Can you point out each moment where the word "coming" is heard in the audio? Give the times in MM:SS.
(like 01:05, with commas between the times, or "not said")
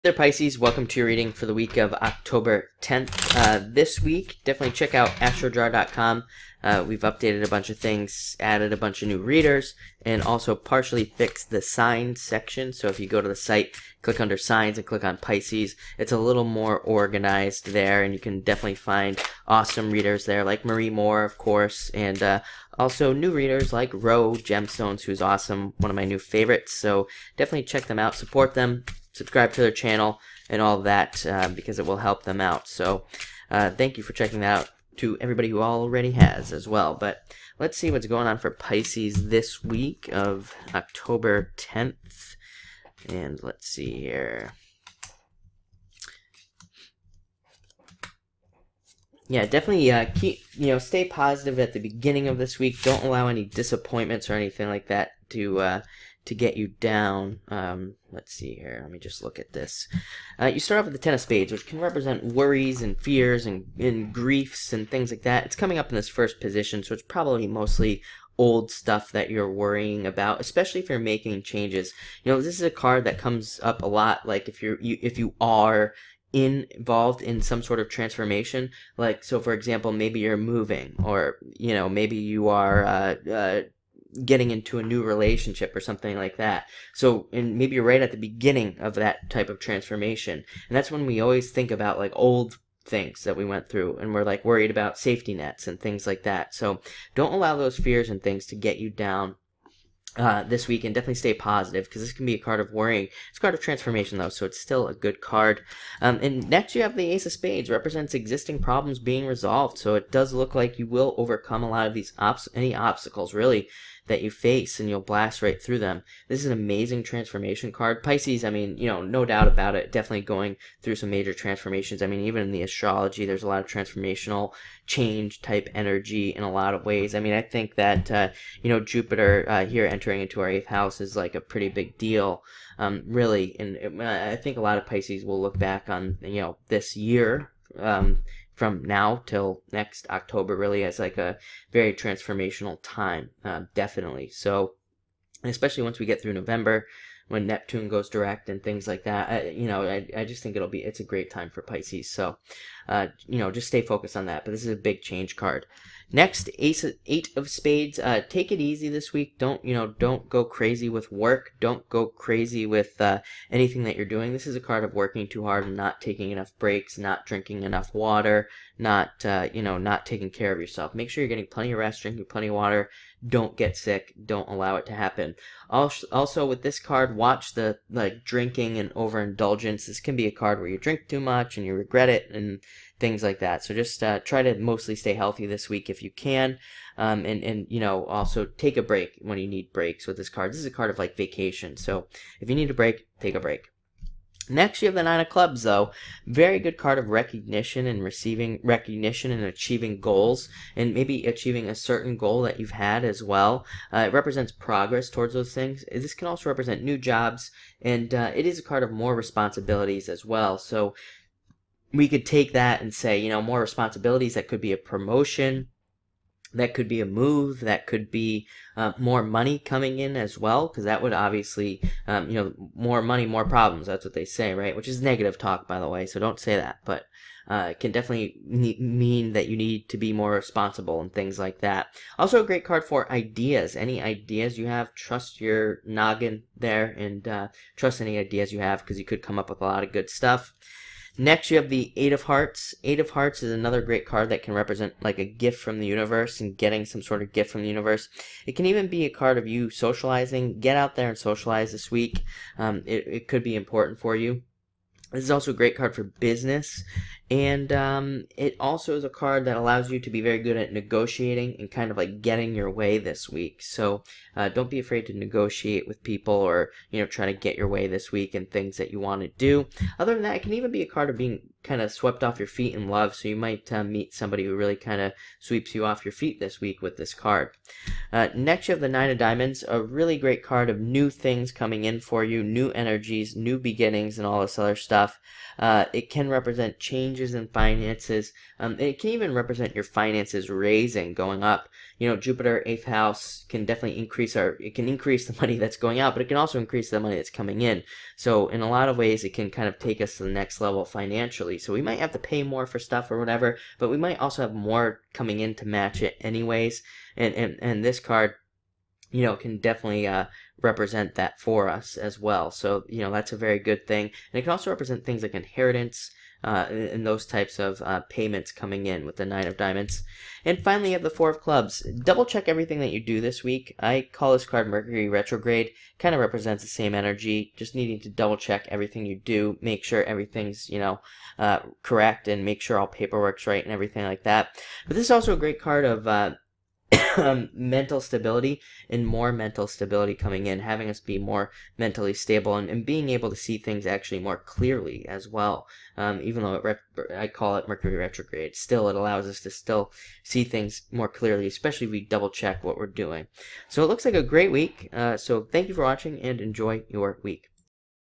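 01:05, 03:39, 04:41, 04:57, 05:05, 05:18, 05:40.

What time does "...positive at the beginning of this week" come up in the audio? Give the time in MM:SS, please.
00:51.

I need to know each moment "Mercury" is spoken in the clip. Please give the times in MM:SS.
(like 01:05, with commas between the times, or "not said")
05:24, 05:47.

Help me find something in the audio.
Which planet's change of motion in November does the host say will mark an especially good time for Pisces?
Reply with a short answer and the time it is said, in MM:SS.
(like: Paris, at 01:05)
Neptune, at 02:27.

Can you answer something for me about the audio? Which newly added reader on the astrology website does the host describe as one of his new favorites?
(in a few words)
Roe Gemstones.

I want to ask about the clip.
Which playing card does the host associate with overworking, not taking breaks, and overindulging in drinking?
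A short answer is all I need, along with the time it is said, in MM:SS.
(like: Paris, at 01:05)
Eight of Spades, at 02:37.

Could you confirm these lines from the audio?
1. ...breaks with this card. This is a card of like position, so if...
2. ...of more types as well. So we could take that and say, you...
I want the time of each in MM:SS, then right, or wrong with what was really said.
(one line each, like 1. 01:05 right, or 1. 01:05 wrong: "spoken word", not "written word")
1. 03:09 wrong: "vacation", not "position"
2. 03:28 wrong: "responsibilities", not "types".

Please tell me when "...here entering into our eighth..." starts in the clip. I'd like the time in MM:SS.
02:09.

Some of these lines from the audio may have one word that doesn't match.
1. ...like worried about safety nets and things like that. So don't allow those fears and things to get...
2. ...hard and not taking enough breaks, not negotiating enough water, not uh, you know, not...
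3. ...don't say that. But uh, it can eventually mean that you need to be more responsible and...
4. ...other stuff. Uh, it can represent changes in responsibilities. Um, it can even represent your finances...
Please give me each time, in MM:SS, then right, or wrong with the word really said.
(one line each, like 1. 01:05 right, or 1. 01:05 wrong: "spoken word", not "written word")
1. 01:34 right
2. 02:45 wrong: "drinking", not "negotiating"
3. 03:46 wrong: "definitely", not "eventually"
4. 04:44 wrong: "finances", not "responsibilities".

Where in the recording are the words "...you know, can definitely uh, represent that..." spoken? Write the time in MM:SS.
05:09.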